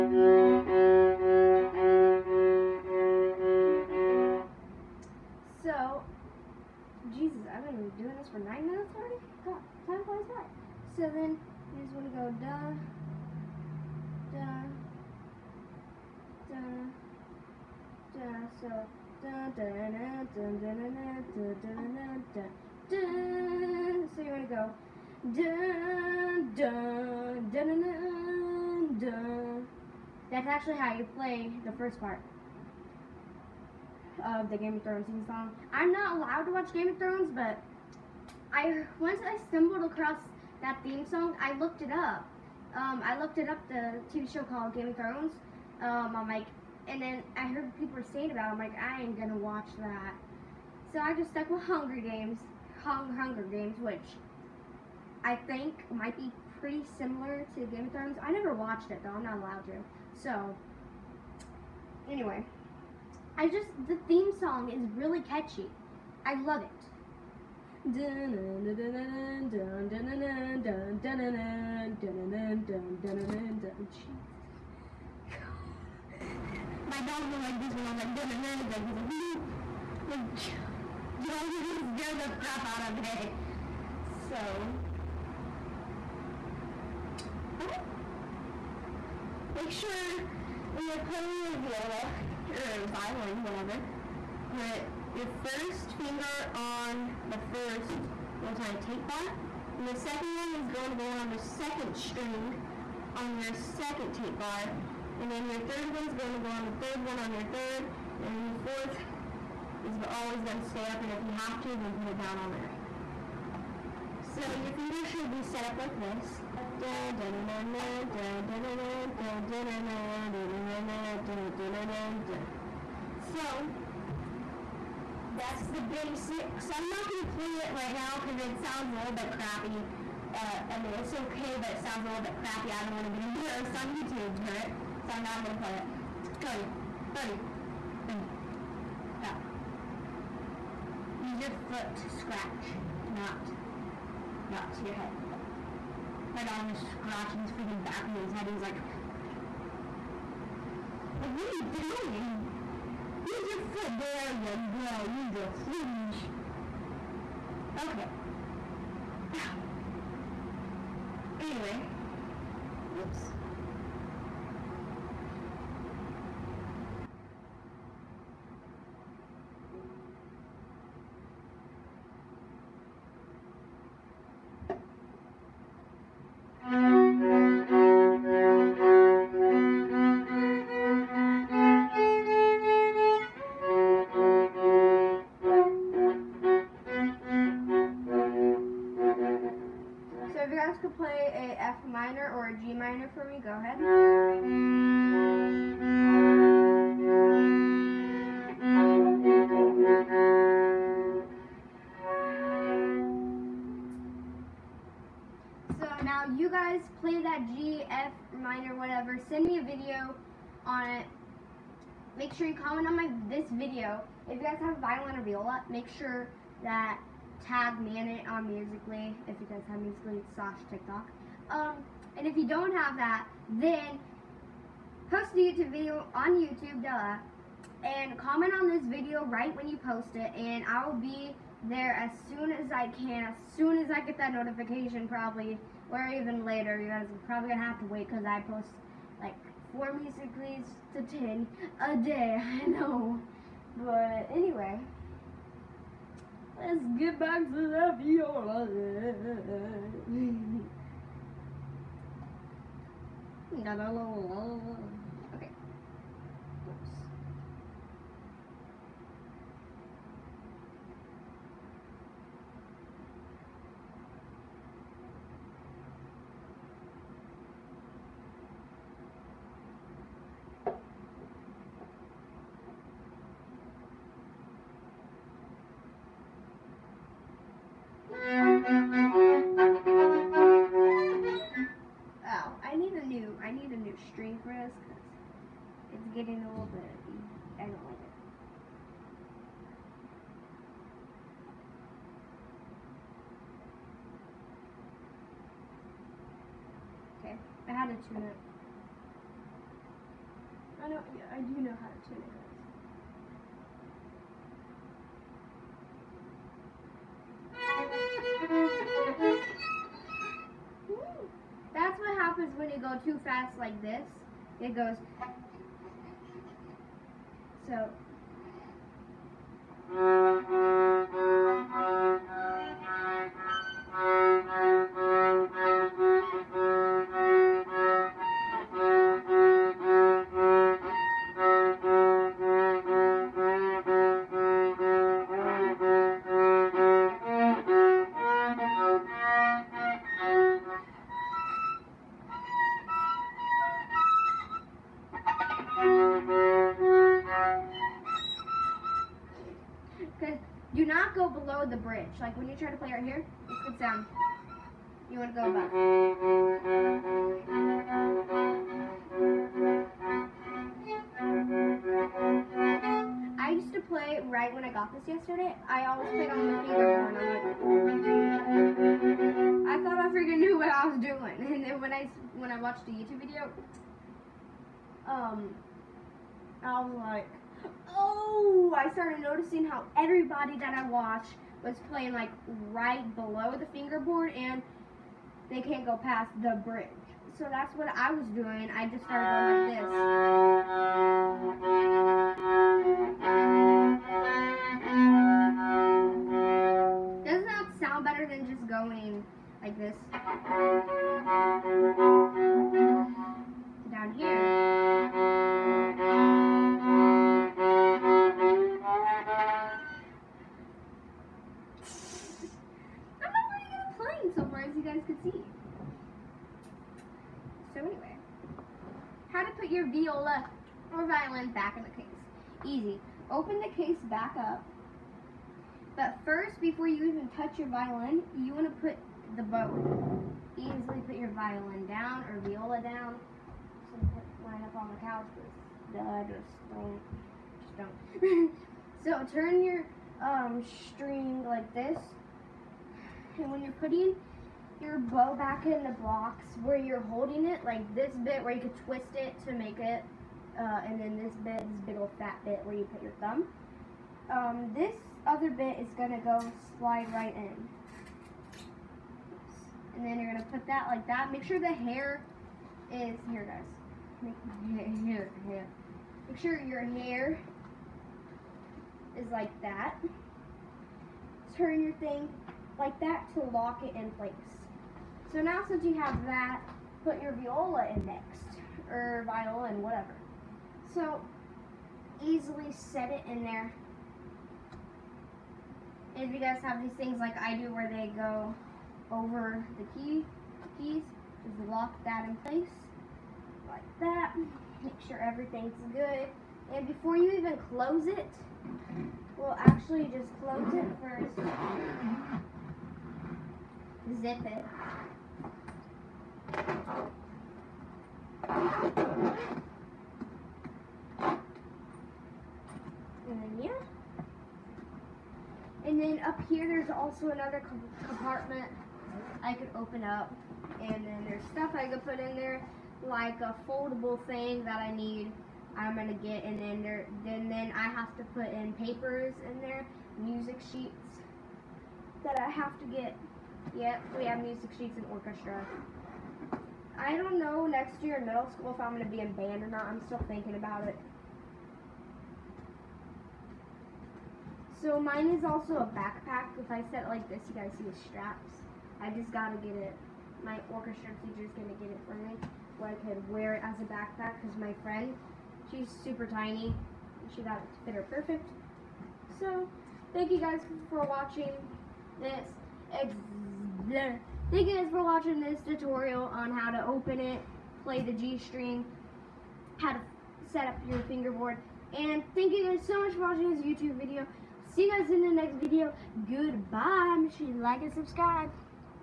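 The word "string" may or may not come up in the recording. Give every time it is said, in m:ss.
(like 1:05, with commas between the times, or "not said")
1:41, 7:20, 9:28.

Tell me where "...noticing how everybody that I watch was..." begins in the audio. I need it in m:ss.
6:19.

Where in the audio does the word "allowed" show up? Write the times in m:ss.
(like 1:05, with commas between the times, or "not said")
0:36, 0:59.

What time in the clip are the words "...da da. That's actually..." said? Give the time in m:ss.
0:27.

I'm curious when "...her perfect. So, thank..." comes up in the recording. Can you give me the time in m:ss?
9:17.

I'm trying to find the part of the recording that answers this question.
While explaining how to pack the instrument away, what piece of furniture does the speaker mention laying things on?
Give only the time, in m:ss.
7:15.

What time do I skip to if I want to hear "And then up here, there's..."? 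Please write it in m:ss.
8:35.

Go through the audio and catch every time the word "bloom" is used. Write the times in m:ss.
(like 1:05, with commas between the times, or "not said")
not said.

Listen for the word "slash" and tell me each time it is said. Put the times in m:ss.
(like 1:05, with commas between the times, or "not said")
3:40.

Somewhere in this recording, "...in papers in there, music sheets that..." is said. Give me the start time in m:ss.
8:48.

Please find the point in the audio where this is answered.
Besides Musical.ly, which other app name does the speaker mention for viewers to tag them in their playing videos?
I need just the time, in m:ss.
3:40.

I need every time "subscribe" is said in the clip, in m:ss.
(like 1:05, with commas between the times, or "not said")
9:37.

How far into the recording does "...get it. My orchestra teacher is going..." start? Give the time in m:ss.
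9:09.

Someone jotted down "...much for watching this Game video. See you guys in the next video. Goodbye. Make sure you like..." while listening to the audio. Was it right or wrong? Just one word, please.
wrong.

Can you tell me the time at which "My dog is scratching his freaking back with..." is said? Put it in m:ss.
2:26.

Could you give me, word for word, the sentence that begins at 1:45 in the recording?
And then your third one's going to go on the third one on your third.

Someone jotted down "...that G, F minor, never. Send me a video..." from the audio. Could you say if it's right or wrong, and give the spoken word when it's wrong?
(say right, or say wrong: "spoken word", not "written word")
wrong: "whatever", not "never".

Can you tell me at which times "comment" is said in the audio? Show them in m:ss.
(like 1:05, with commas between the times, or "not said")
3:32, 3:48.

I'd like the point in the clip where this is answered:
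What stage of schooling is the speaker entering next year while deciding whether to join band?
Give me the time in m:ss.
8:58.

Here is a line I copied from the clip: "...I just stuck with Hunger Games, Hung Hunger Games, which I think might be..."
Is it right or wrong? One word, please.
right.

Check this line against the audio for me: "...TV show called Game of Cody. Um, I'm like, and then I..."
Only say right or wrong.
wrong.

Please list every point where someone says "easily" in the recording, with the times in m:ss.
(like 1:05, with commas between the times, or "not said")
7:10, 8:02.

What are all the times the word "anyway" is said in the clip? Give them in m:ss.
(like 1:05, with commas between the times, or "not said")
1:02, 2:41, 4:04, 6:57.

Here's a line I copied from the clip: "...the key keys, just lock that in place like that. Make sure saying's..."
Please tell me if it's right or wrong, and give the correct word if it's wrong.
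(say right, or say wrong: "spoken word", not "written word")
wrong: "everything", not "saying".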